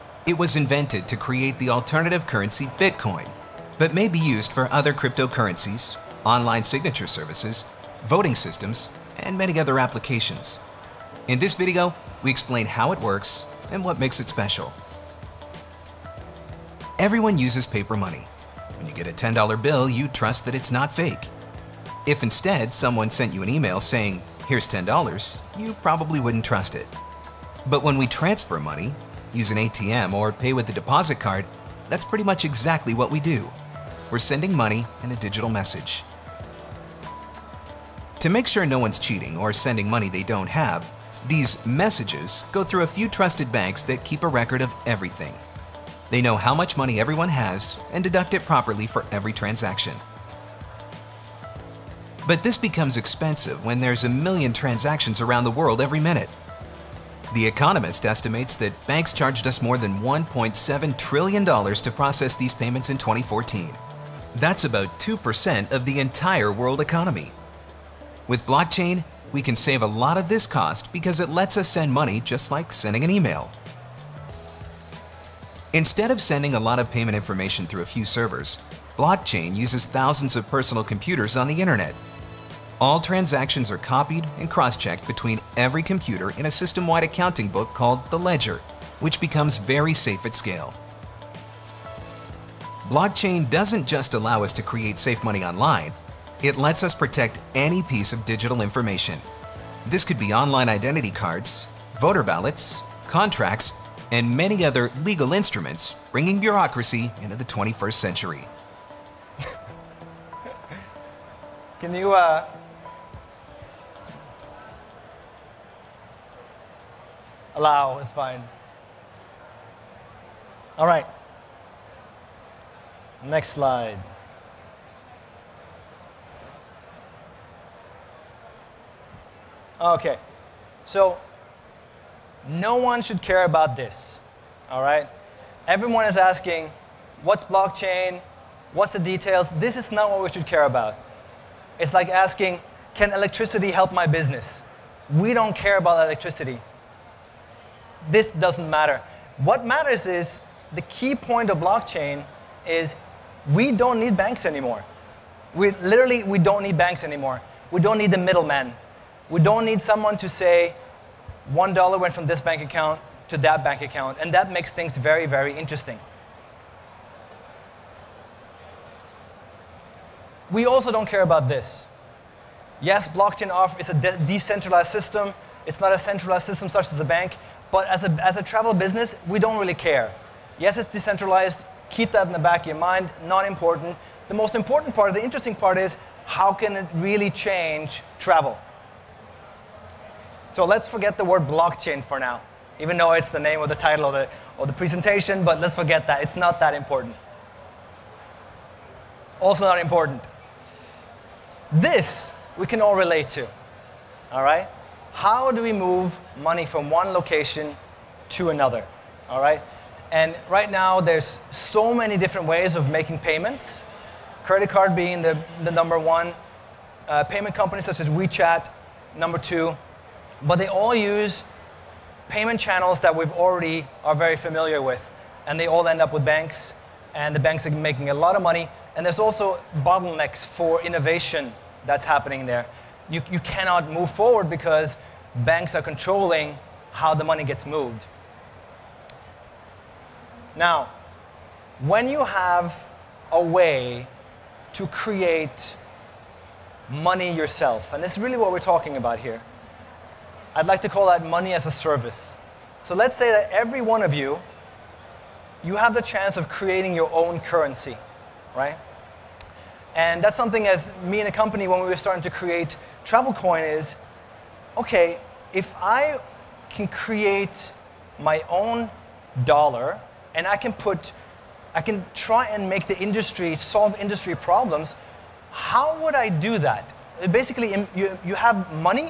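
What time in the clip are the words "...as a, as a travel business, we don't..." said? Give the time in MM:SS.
02:57.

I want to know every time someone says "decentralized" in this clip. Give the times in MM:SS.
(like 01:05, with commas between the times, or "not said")
02:54, 03:00.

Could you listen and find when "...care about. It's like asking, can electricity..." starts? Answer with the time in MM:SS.
02:20.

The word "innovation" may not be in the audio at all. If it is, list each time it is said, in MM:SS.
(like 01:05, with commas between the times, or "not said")
03:50.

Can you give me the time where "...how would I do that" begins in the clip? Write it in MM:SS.
04:35.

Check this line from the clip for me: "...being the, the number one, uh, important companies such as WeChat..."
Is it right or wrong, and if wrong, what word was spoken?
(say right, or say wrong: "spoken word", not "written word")
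wrong: "payment", not "important".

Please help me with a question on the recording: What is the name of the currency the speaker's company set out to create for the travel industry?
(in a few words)
Travelkoin.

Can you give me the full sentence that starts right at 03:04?
The most important part, the interesting part is how can it really change travel?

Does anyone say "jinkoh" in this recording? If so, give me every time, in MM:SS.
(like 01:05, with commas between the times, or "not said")
not said.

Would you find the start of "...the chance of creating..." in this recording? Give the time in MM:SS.
04:15.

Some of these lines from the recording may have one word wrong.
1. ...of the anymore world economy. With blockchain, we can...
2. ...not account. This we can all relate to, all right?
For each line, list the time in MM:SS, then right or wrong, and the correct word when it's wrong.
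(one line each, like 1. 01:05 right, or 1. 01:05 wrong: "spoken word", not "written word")
1. 01:05 wrong: "entire", not "anymore"
2. 03:19 wrong: "important", not "account".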